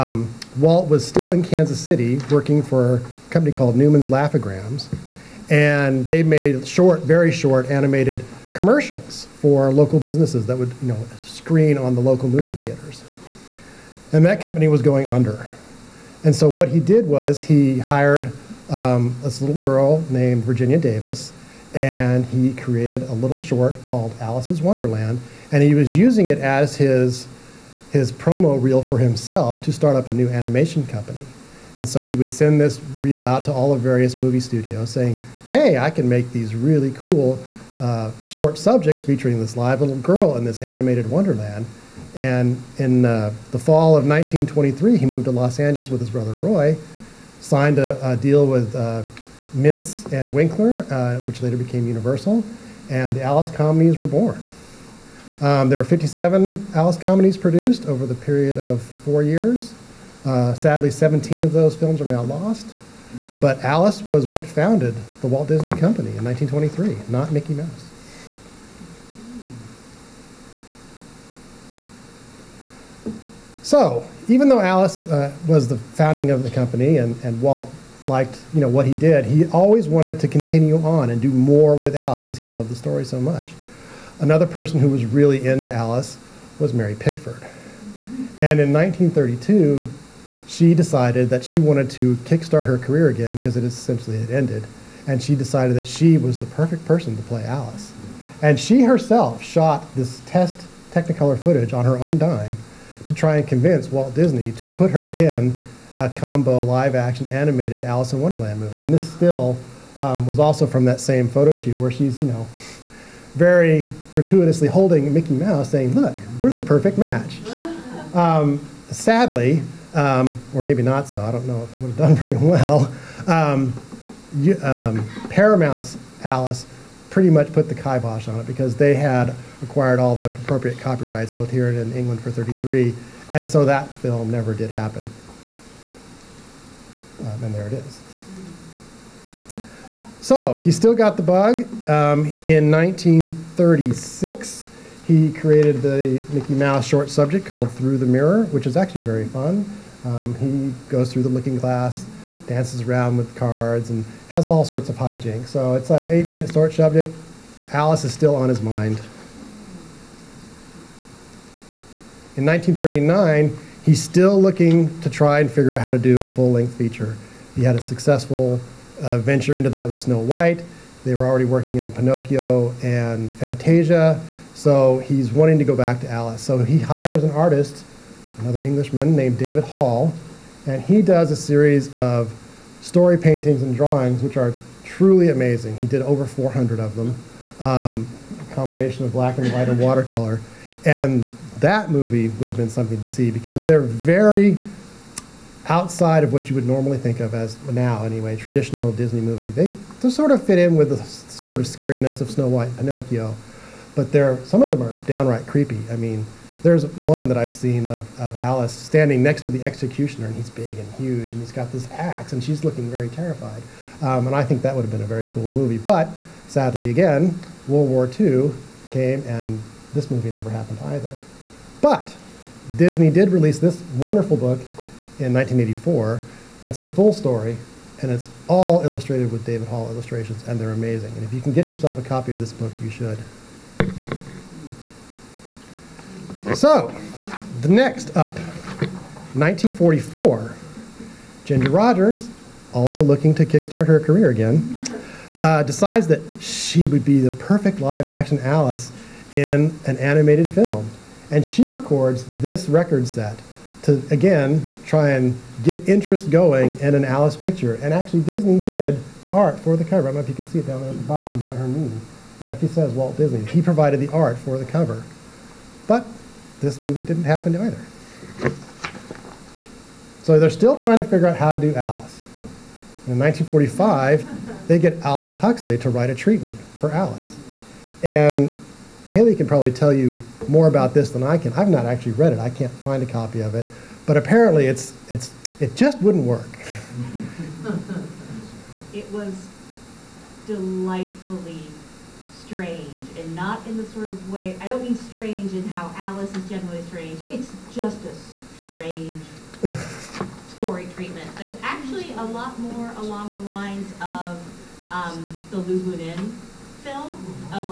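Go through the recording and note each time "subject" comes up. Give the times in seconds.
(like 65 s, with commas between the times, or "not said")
38 s, 147 s, 156 s.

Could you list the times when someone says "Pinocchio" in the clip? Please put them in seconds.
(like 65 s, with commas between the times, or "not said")
171 s, 202 s.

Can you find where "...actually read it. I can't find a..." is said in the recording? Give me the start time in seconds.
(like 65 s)
281 s.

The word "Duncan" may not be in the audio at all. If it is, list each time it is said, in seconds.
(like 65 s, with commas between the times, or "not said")
not said.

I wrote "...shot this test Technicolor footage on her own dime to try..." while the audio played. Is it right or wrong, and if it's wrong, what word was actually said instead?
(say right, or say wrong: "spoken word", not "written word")
right.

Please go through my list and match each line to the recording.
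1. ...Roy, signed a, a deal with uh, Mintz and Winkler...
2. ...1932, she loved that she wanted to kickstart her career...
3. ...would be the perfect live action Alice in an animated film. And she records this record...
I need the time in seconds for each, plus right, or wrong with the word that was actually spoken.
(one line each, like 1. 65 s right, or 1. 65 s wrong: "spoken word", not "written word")
1. 46 s right
2. 88 s wrong: "decided", not "loved"
3. 246 s right.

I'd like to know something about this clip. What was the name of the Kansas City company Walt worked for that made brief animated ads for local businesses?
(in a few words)
Newman's Laugh-O-Grams.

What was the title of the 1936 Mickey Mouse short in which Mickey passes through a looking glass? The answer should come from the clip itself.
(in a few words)
Through the Mirror.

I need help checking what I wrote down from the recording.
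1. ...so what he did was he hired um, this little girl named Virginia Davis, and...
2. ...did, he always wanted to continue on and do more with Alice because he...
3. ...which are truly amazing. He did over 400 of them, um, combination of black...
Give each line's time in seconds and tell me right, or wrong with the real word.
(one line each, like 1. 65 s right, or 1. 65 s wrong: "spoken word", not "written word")
1. 16 s right
2. 78 s right
3. 184 s right.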